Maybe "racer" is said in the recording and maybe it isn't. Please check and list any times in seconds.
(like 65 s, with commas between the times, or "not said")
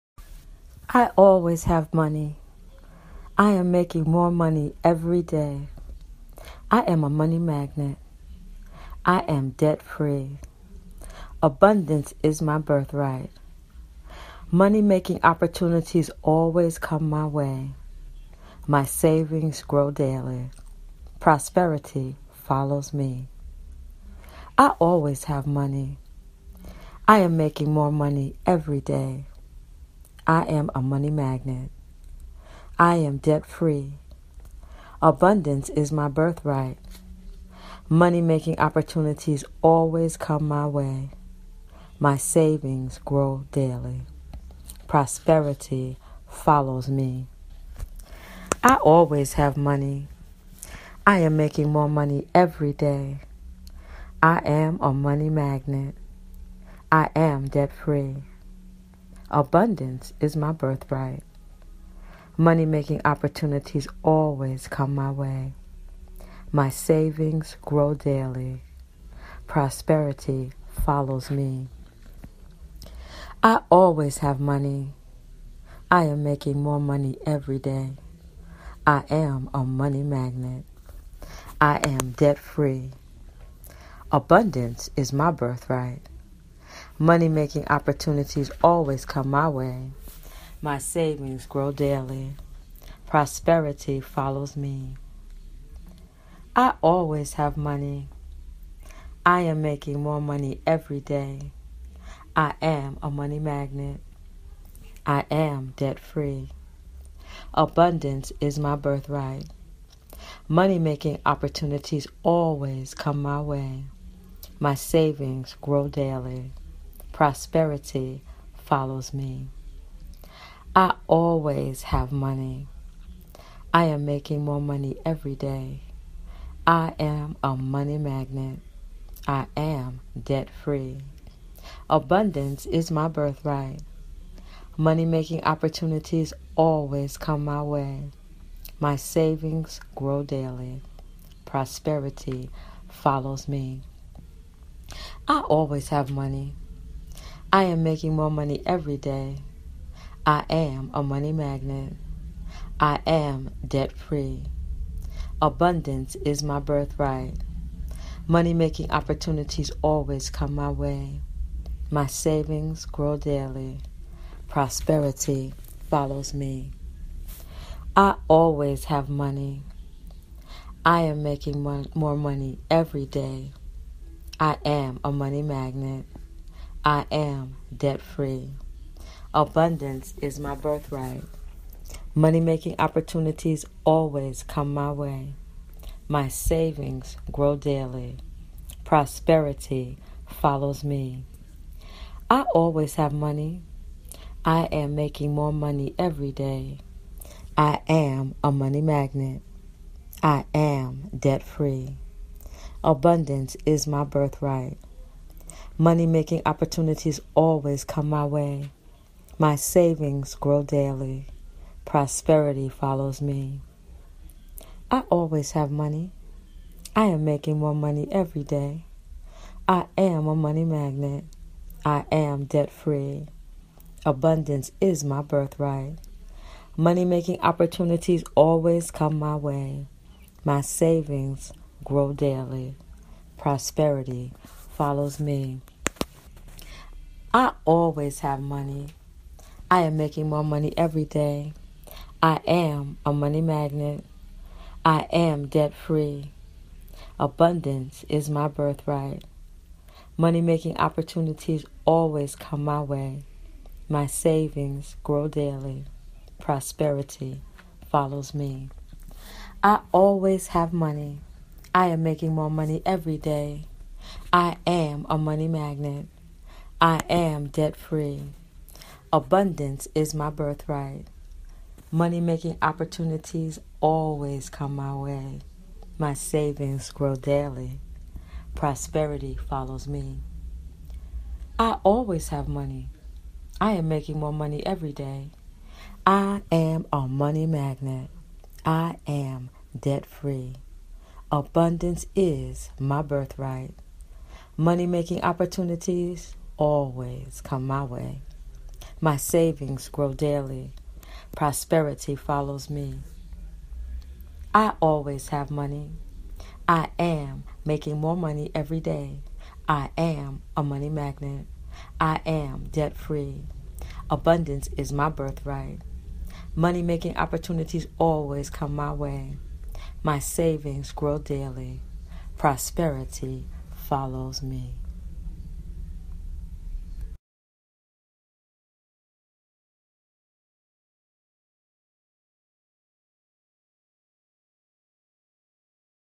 not said.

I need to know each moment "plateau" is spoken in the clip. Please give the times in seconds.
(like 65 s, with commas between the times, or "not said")
not said.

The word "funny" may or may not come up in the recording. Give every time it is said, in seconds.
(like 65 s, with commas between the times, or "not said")
not said.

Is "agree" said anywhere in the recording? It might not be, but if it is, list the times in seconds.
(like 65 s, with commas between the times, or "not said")
not said.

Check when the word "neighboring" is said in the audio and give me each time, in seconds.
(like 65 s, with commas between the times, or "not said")
not said.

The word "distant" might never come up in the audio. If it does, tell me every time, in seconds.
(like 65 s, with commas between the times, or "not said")
not said.